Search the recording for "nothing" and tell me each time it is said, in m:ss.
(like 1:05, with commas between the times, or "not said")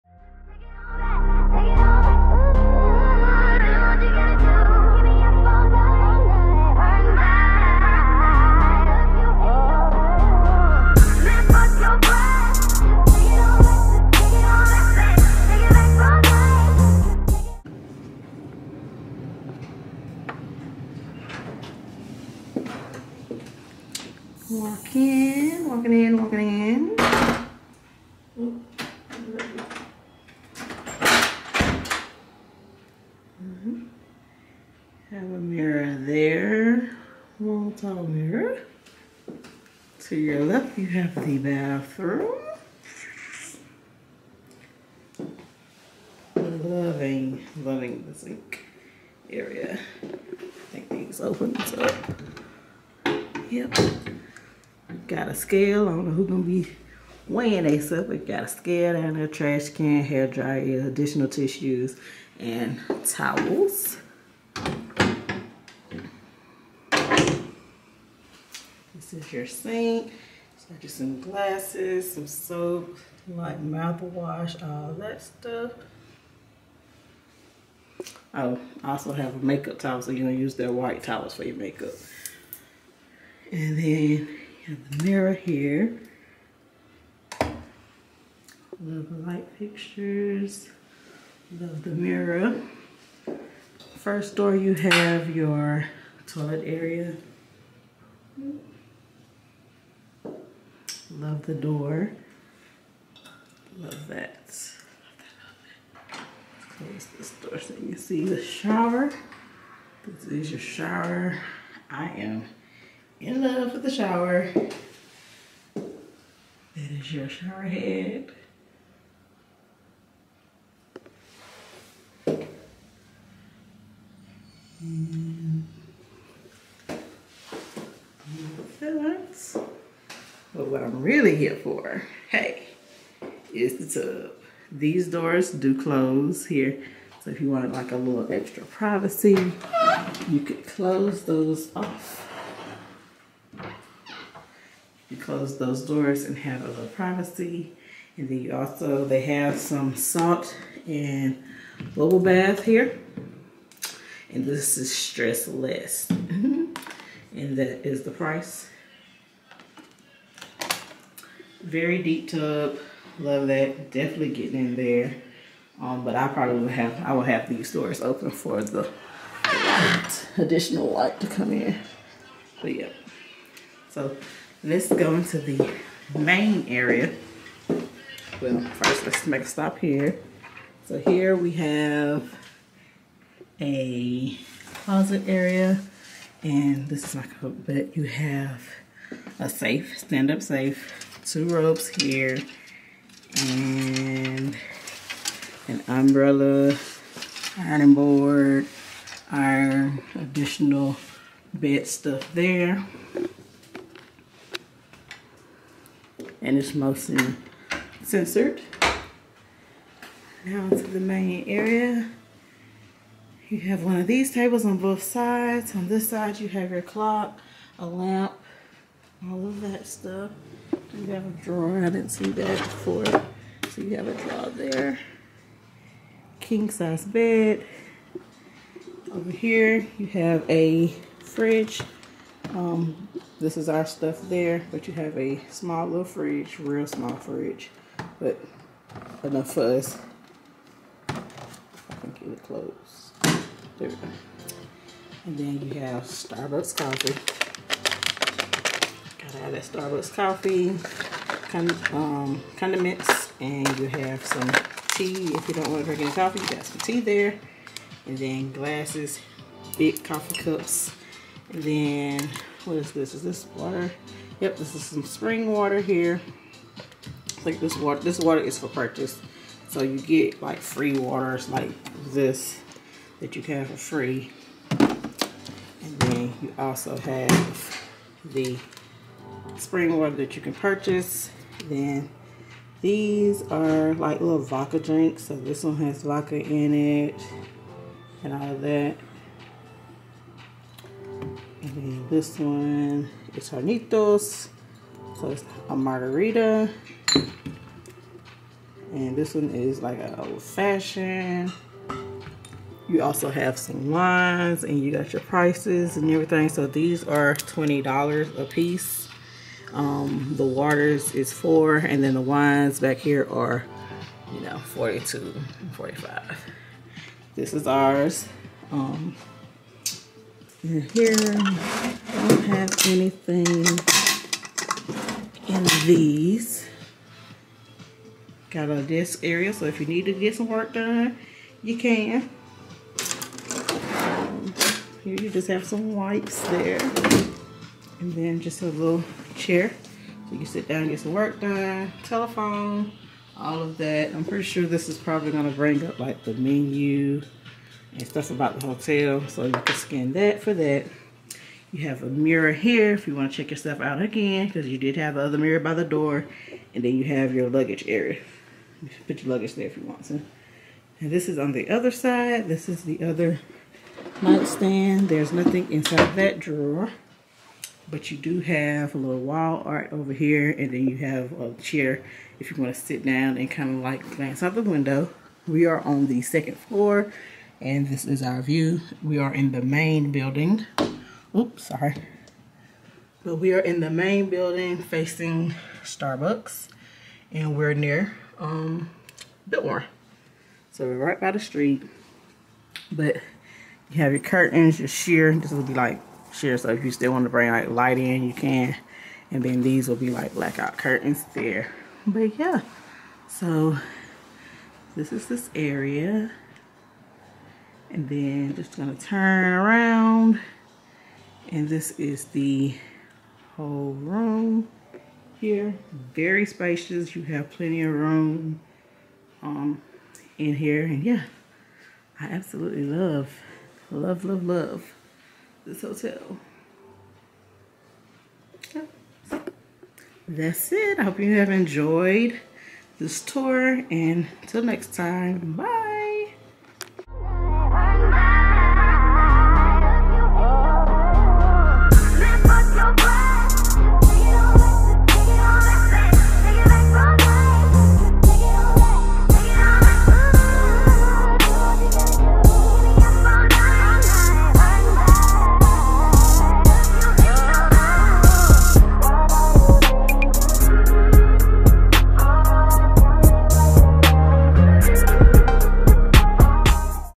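6:05.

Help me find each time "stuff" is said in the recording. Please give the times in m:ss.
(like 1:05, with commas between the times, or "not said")
1:15, 3:21, 3:39, 3:53, 5:48.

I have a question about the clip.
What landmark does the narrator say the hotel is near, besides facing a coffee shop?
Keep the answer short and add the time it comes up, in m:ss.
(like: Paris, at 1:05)
Biltmore, at 6:29.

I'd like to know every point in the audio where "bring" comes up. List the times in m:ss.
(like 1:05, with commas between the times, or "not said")
5:45, 6:37.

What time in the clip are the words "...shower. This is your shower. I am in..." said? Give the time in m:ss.
1:48.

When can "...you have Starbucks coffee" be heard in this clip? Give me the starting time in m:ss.
4:05.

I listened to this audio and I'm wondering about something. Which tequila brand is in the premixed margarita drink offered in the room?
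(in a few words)
Hornitos.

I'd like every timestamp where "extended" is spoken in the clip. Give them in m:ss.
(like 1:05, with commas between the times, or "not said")
not said.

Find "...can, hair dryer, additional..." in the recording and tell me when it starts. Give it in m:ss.
0:59.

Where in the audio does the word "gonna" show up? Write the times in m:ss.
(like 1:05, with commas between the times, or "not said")
0:56, 1:20, 6:48.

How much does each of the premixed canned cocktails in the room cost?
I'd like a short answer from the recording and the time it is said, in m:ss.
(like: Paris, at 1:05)
$20, at 5:07.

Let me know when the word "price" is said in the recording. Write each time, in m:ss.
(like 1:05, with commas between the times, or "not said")
2:38, 5:05.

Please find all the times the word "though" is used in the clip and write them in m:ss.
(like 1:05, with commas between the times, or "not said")
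not said.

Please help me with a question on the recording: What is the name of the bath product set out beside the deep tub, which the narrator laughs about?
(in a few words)
Stress less.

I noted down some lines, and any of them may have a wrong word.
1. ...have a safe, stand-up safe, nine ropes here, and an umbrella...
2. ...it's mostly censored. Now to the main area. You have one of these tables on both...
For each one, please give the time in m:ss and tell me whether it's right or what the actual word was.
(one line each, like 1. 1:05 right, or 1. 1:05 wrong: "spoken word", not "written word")
1. 3:08 wrong: "two", not "nine"
2. 3:26 right.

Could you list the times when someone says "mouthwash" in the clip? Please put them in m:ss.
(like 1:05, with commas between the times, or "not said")
1:13.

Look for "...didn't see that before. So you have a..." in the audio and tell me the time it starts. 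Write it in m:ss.
3:41.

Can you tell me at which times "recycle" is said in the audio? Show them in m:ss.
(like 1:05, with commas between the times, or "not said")
not said.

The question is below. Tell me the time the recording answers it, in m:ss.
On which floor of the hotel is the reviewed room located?
6:16.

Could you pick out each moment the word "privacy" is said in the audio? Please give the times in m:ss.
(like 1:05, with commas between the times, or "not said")
2:18, 2:26.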